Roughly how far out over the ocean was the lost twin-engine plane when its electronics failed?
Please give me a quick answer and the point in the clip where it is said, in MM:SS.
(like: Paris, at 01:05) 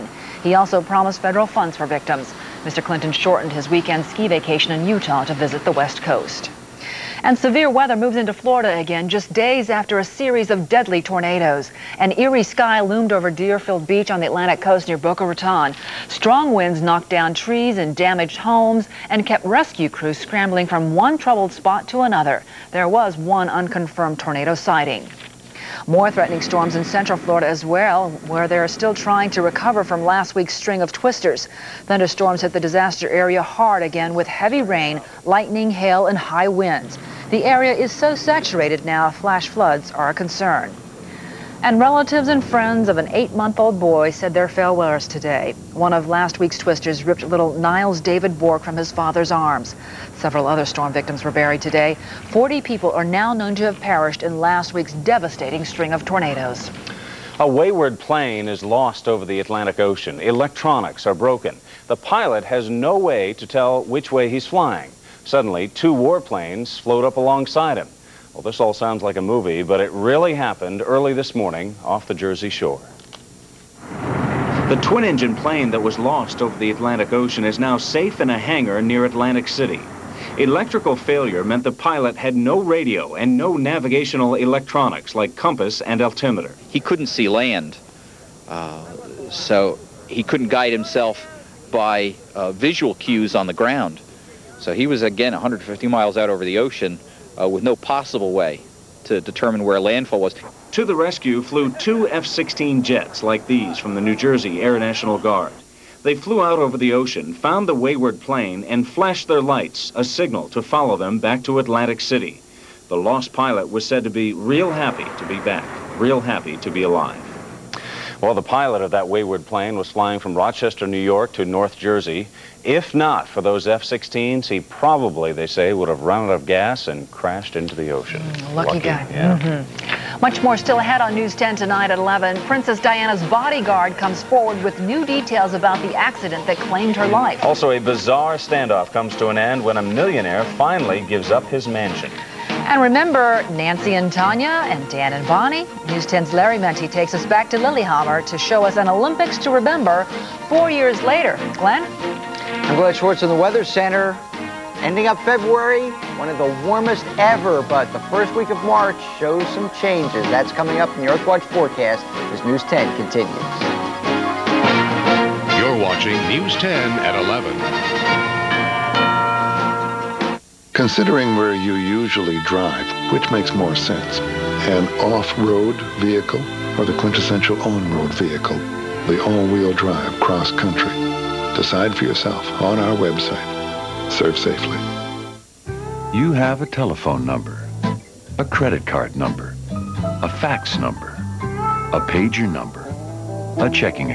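150 miles, at 01:35.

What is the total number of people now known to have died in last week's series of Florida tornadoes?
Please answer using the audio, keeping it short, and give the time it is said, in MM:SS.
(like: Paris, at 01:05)
40, at 00:52.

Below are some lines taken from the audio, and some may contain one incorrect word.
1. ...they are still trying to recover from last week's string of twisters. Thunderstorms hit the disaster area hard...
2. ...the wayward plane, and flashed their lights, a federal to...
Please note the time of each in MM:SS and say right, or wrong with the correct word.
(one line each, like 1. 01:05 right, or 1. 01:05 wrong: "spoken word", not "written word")
1. 00:28 right
2. 01:47 wrong: "signal", not "federal".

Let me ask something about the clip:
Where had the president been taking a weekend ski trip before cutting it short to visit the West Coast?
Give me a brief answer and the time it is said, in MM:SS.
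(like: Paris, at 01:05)
Utah, at 00:04.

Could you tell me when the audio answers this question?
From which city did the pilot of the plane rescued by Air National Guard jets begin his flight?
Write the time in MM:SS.
02:00.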